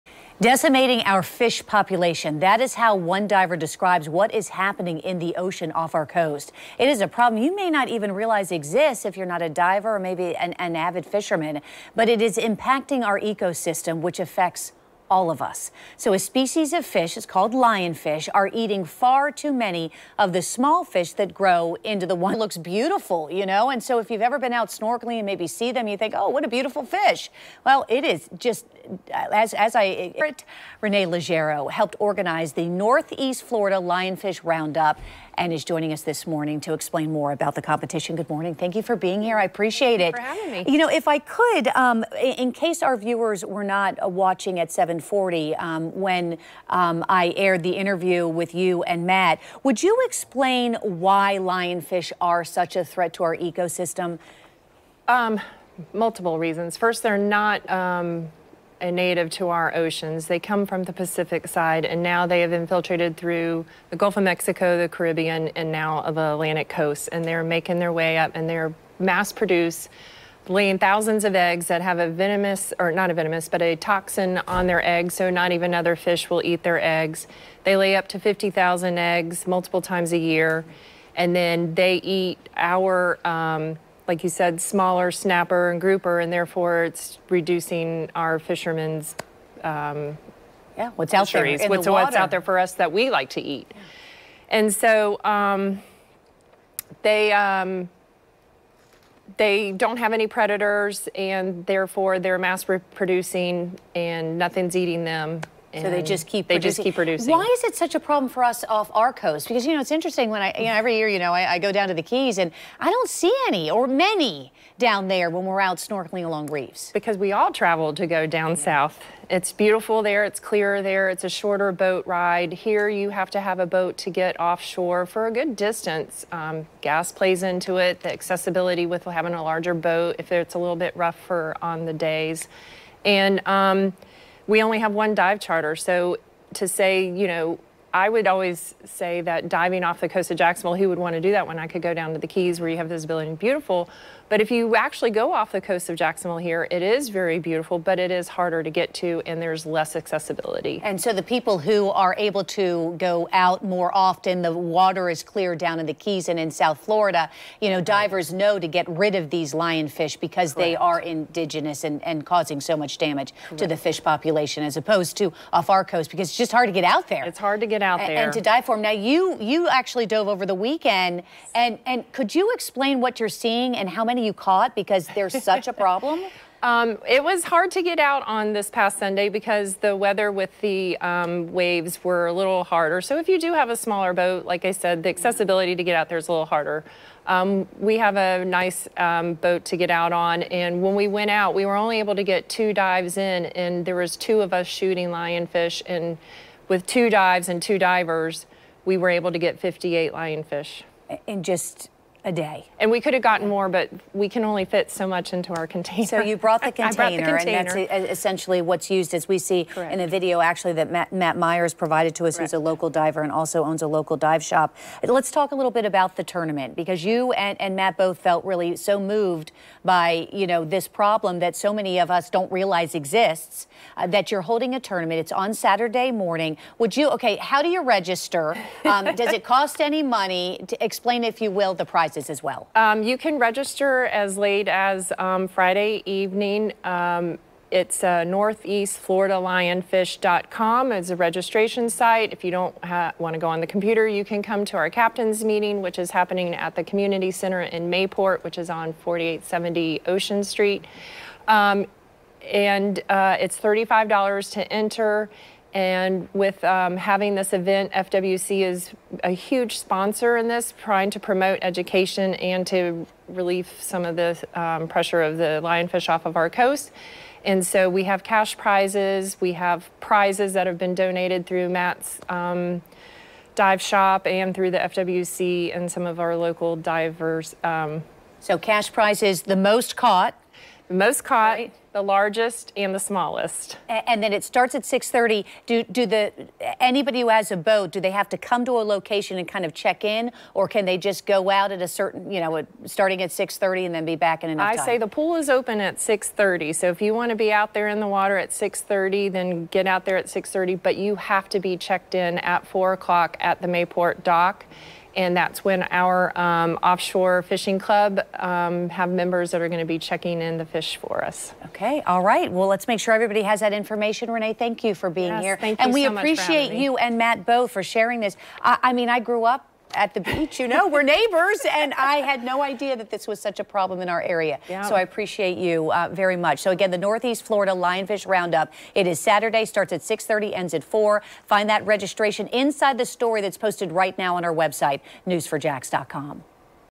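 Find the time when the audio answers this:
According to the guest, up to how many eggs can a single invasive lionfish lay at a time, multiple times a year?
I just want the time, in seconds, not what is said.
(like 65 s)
78 s.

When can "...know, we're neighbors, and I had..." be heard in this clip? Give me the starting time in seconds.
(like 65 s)
320 s.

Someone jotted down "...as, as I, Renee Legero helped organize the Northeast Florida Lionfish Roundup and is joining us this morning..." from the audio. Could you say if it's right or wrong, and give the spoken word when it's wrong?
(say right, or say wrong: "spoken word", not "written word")
right.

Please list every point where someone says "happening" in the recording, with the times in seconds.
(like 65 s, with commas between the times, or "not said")
4 s, 246 s.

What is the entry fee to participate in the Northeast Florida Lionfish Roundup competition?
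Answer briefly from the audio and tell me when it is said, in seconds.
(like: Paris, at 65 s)
$35, at 253 s.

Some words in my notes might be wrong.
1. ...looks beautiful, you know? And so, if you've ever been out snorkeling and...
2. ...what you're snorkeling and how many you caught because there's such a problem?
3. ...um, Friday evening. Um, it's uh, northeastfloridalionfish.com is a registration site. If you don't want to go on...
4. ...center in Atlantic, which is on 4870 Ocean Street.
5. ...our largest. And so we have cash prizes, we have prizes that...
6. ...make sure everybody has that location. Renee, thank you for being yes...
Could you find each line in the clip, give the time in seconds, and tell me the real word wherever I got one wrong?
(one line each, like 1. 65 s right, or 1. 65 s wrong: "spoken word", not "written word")
1. 22 s right
2. 173 s wrong: "seeing", not "snorkeling"
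3. 235 s right
4. 247 s wrong: "Mayport", not "Atlantic"
5. 266 s wrong: "coast", not "largest"
6. 312 s wrong: "information", not "location".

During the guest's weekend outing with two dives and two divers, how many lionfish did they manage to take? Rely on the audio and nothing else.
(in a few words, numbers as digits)
58.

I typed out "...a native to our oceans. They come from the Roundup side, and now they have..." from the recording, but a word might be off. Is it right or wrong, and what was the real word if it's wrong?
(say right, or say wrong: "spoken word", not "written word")
wrong: "Pacific", not "Roundup".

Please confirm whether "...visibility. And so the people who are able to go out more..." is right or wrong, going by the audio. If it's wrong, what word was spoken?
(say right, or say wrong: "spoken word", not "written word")
wrong: "accessibility", not "visibility".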